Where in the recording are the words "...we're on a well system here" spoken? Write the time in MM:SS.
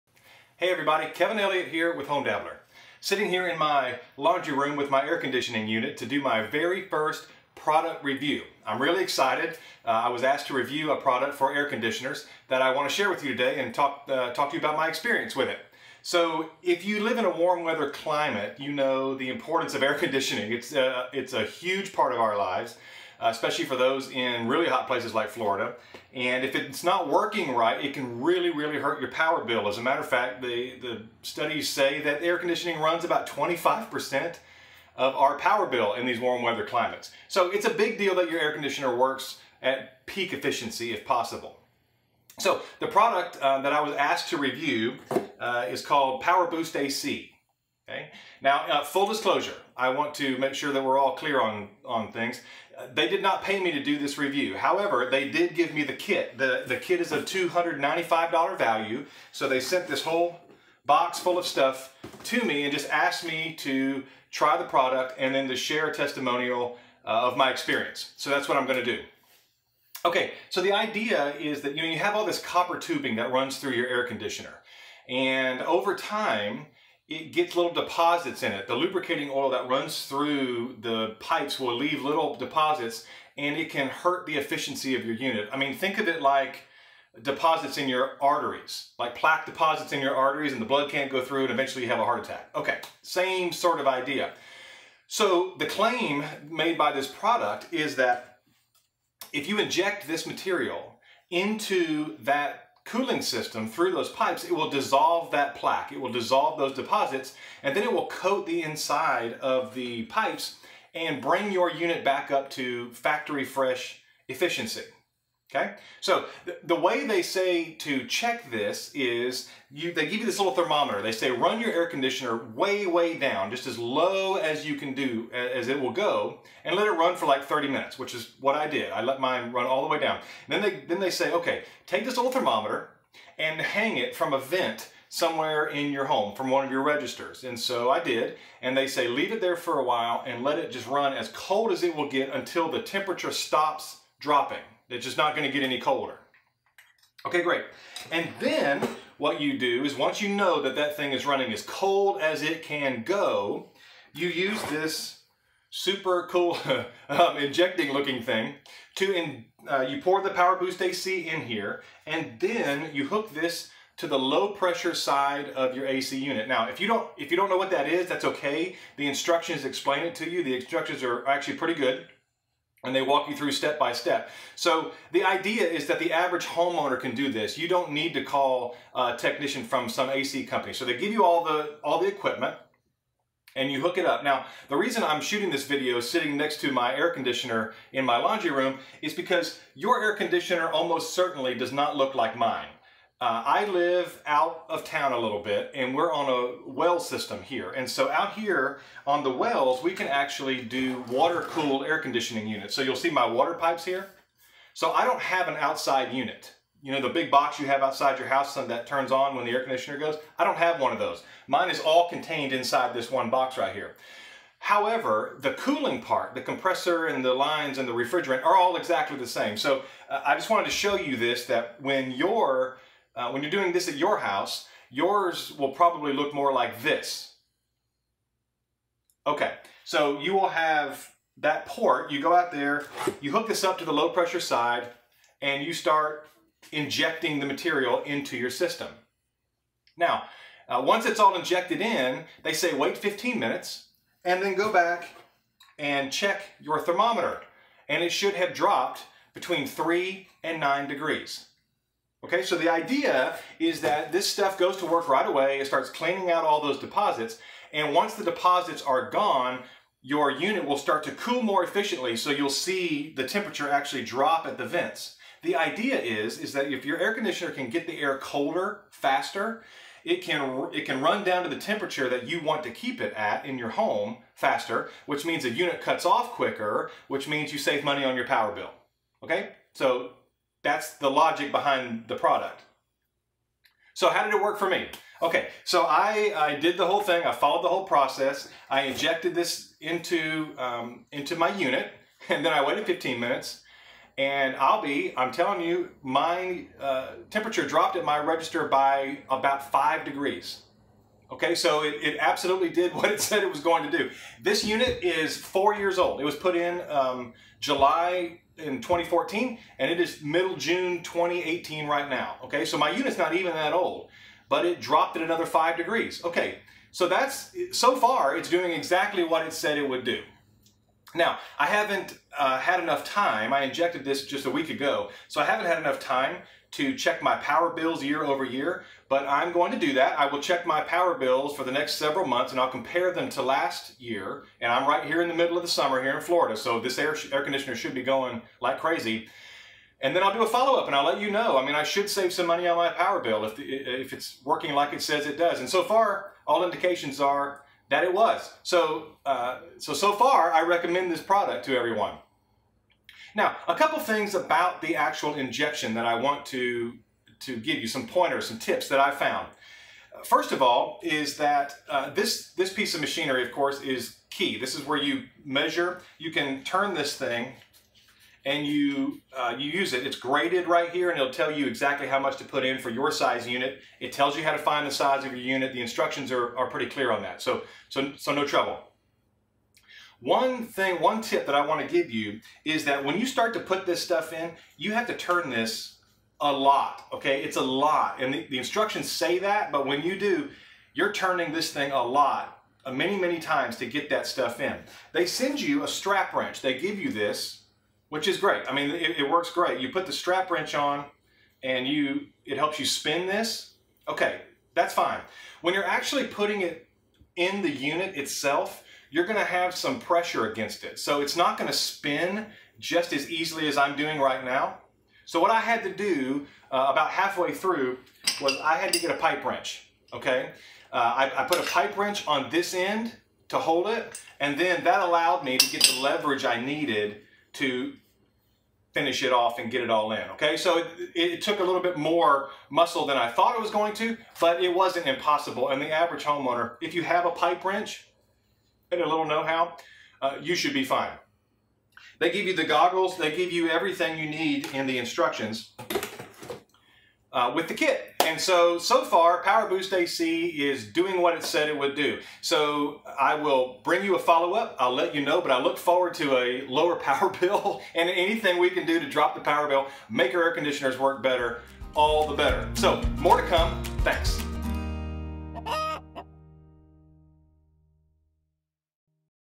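03:15.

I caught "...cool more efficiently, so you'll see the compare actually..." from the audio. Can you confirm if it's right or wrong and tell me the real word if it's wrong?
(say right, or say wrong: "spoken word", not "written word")
wrong: "temperature", not "compare".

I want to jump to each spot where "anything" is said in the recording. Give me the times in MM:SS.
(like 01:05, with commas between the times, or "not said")
07:38.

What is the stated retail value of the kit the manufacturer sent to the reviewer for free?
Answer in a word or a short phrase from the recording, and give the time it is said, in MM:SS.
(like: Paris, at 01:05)
$295, at 00:57.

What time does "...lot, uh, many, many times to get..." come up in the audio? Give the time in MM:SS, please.
06:32.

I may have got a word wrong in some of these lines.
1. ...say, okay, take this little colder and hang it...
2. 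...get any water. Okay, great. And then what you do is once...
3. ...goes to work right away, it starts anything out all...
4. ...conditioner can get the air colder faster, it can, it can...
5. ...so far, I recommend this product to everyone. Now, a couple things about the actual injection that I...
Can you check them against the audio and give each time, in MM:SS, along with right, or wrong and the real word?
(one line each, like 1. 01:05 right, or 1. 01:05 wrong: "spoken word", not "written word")
1. 02:11 wrong: "thermometer", not "colder"
2. 02:25 wrong: "colder", not "water"
3. 04:14 wrong: "cleaning", not "anything"
4. 04:27 right
5. 05:49 right.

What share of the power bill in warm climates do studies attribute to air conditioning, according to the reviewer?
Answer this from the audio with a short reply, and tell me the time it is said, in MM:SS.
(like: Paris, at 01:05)
25%, at 00:33.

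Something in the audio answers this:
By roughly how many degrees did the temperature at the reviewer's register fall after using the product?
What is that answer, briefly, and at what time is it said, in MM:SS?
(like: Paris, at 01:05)
5 degrees, at 04:59.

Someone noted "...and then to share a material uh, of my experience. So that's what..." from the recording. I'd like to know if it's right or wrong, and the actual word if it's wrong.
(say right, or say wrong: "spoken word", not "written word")
wrong: "testimonial", not "material".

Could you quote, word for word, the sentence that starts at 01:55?
Okay, so th the way they say to check this is you, they give you this little thermometer.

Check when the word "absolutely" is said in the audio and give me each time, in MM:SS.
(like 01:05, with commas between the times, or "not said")
05:02.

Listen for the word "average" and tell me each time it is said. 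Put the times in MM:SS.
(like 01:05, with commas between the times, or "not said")
02:56, 07:15.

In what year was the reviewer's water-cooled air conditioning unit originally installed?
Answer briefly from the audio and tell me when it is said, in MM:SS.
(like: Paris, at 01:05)
2014, at 05:08.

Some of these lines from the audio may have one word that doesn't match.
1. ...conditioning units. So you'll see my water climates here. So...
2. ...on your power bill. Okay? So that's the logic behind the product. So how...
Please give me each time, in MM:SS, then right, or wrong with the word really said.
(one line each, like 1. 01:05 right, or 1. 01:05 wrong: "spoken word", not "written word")
1. 03:21 wrong: "pipes", not "climates"
2. 04:38 right.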